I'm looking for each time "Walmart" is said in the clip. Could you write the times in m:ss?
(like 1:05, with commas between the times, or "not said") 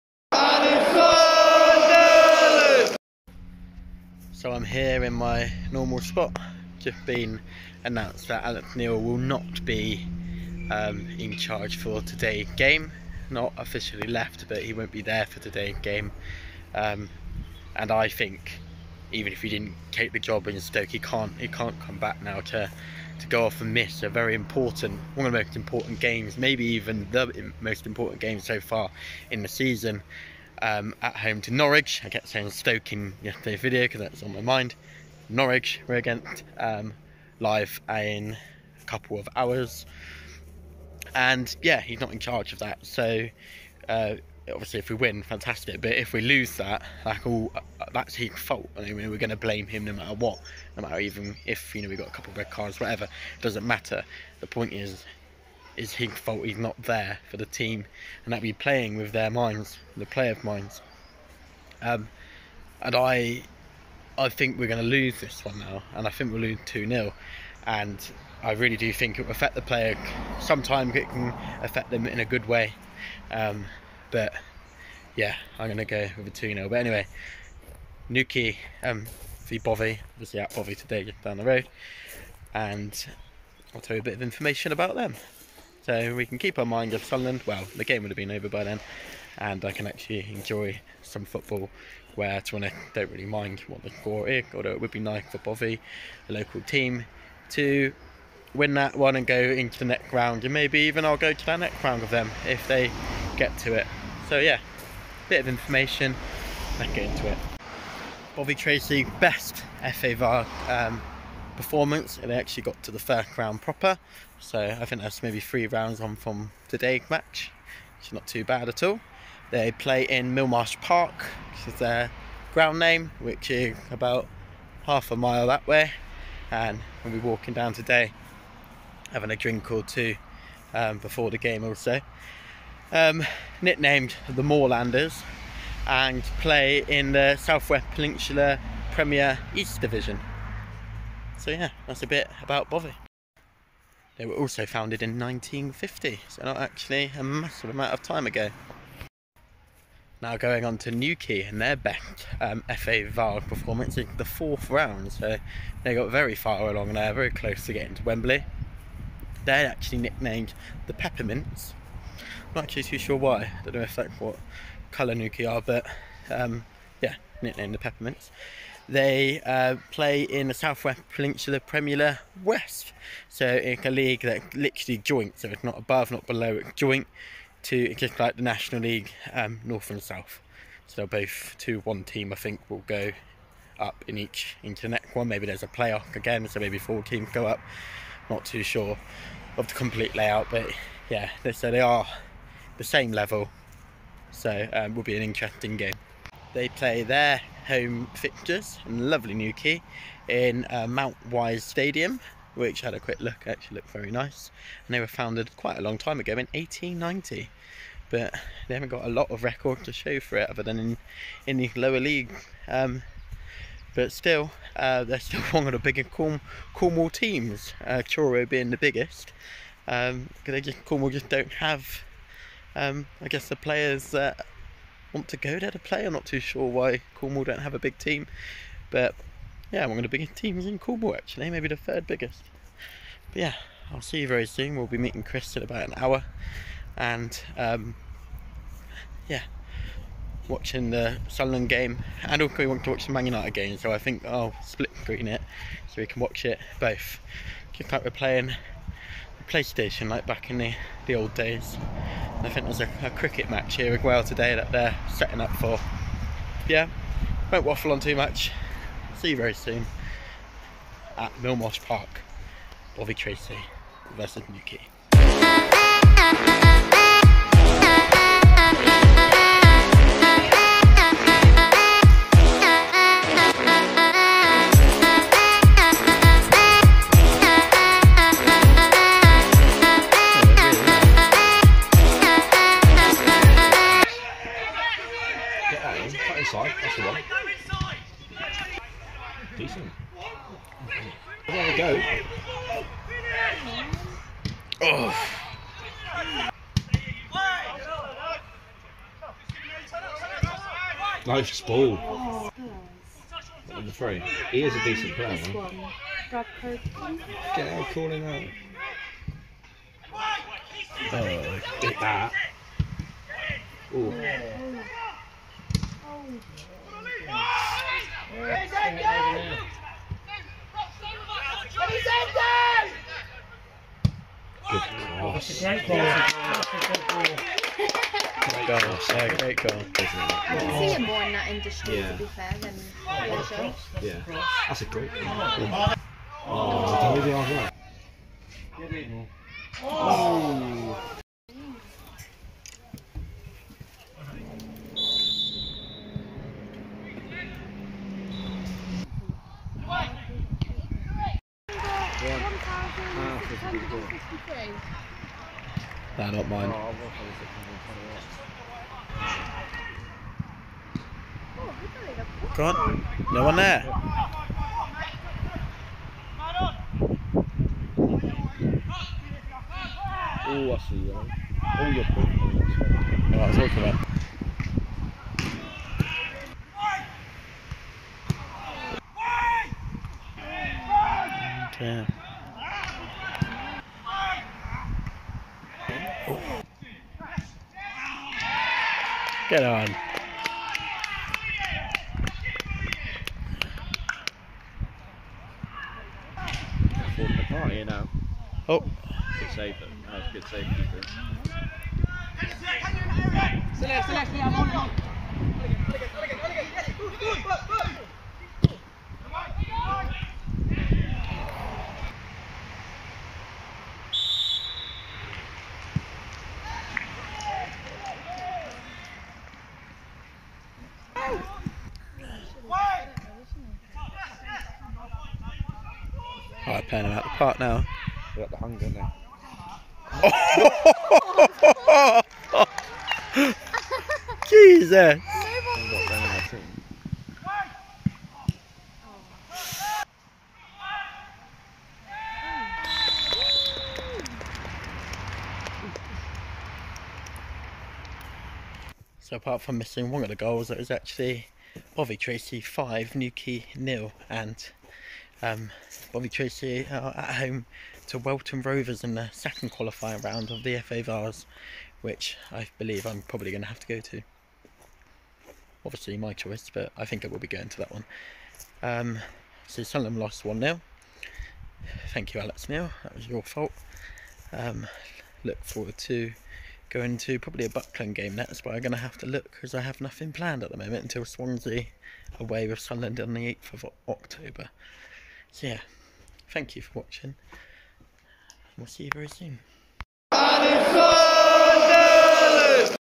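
not said.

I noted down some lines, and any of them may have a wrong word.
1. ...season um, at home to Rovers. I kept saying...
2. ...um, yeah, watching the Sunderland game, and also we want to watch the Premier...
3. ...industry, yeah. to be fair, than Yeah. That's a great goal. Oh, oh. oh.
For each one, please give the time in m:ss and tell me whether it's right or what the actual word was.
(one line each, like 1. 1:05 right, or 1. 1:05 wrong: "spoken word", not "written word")
1. 0:29 wrong: "Norwich", not "Rovers"
2. 3:57 wrong: "Man", not "Premier"
3. 5:31 right.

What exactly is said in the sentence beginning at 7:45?
Obviously my choice, but I think I will be going to that one.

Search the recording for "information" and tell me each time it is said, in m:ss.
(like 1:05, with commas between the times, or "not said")
1:24, 1:45.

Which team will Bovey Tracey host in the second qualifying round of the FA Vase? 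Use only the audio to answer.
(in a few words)
Welton Rovers.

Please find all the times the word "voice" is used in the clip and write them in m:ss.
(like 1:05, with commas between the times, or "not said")
not said.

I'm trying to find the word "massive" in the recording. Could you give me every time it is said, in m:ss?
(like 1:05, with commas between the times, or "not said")
2:27.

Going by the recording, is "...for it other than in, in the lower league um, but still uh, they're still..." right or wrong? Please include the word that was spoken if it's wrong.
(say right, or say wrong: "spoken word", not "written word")
right.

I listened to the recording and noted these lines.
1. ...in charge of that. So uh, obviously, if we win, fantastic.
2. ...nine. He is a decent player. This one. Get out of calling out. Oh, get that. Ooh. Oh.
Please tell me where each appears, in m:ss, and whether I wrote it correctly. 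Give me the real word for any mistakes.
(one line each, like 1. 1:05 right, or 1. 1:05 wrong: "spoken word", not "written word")
1. 0:42 right
2. 5:03 wrong: "three", not "nine".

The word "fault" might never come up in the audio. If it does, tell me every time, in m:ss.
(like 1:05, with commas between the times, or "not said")
0:48, 0:56, 7:53.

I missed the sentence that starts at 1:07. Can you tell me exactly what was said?
And I really do think it will affect the player.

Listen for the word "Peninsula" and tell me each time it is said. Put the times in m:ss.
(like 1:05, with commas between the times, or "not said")
2:17, 2:51.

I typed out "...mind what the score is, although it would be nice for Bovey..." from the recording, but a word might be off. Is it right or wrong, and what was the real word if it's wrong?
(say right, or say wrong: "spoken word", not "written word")
right.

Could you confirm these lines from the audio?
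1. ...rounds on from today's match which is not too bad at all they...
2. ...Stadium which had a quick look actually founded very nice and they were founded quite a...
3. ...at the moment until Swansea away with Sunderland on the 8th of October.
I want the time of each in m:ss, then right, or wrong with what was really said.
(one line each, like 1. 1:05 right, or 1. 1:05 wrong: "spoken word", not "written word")
1. 1:55 right
2. 3:21 wrong: "looked", not "founded"
3. 8:00 right.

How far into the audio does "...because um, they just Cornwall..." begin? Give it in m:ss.
3:39.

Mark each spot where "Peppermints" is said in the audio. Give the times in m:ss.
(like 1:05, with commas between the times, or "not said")
2:40, 2:47.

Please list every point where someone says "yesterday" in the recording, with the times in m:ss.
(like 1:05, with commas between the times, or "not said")
0:33.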